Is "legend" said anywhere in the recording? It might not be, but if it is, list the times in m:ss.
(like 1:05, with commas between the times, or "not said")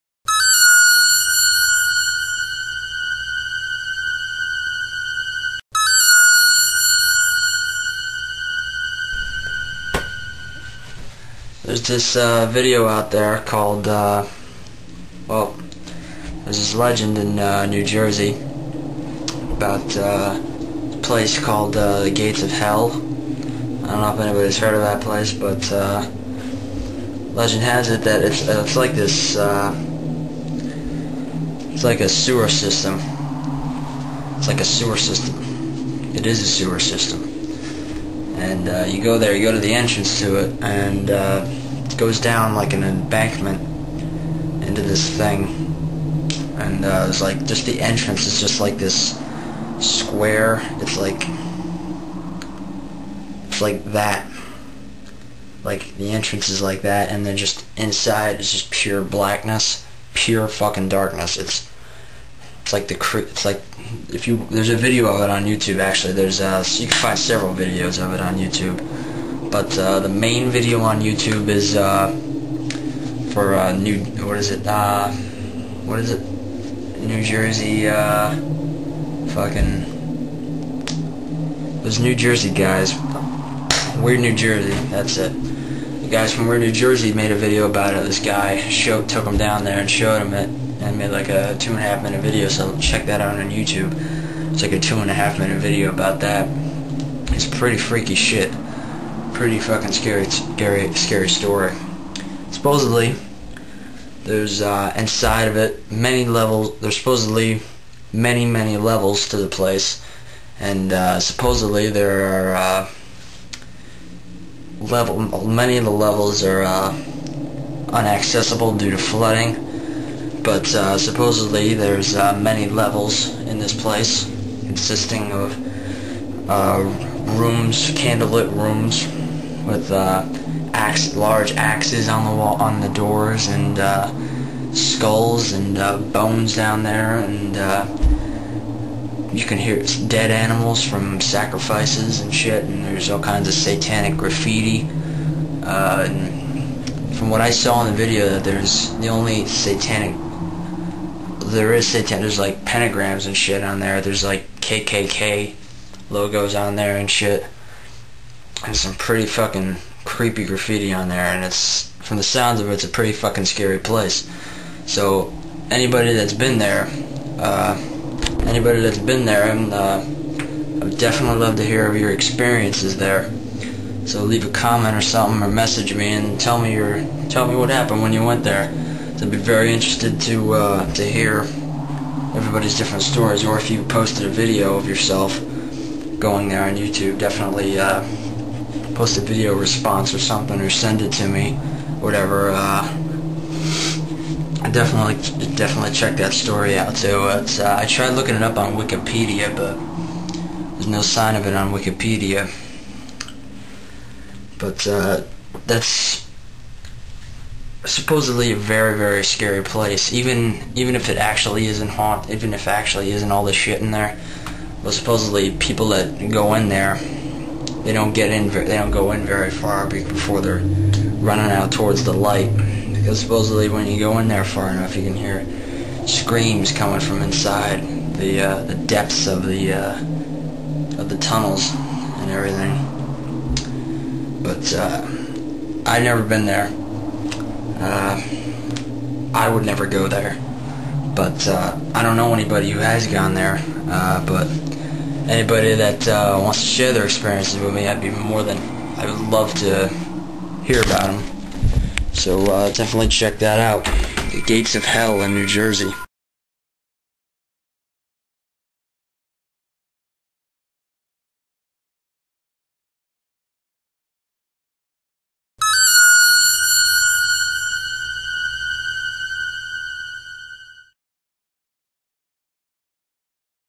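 0:16, 0:27.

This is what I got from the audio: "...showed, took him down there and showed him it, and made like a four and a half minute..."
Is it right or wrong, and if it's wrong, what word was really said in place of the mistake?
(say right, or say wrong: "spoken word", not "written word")
wrong: "two", not "four".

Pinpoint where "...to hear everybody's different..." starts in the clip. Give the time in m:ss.
3:00.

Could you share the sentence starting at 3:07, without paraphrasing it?
Uh, post a video response or something or send it to me, whatever.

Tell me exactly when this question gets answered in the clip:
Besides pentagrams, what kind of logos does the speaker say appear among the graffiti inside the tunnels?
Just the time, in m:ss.
2:34.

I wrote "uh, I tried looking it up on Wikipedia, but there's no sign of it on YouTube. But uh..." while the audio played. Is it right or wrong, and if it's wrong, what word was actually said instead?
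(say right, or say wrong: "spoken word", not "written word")
wrong: "Wikipedia", not "YouTube".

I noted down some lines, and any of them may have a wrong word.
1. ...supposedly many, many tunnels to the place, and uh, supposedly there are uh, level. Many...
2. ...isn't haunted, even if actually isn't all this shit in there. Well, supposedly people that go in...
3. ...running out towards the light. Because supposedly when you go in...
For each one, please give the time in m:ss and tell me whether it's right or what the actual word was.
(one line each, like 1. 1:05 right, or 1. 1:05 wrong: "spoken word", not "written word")
1. 1:46 wrong: "levels", not "tunnels"
2. 3:31 right
3. 3:41 right.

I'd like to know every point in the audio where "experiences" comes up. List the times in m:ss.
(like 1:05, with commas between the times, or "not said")
2:52, 4:07.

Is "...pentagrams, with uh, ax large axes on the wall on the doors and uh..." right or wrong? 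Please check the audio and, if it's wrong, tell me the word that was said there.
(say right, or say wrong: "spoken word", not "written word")
wrong: "rooms", not "pentagrams".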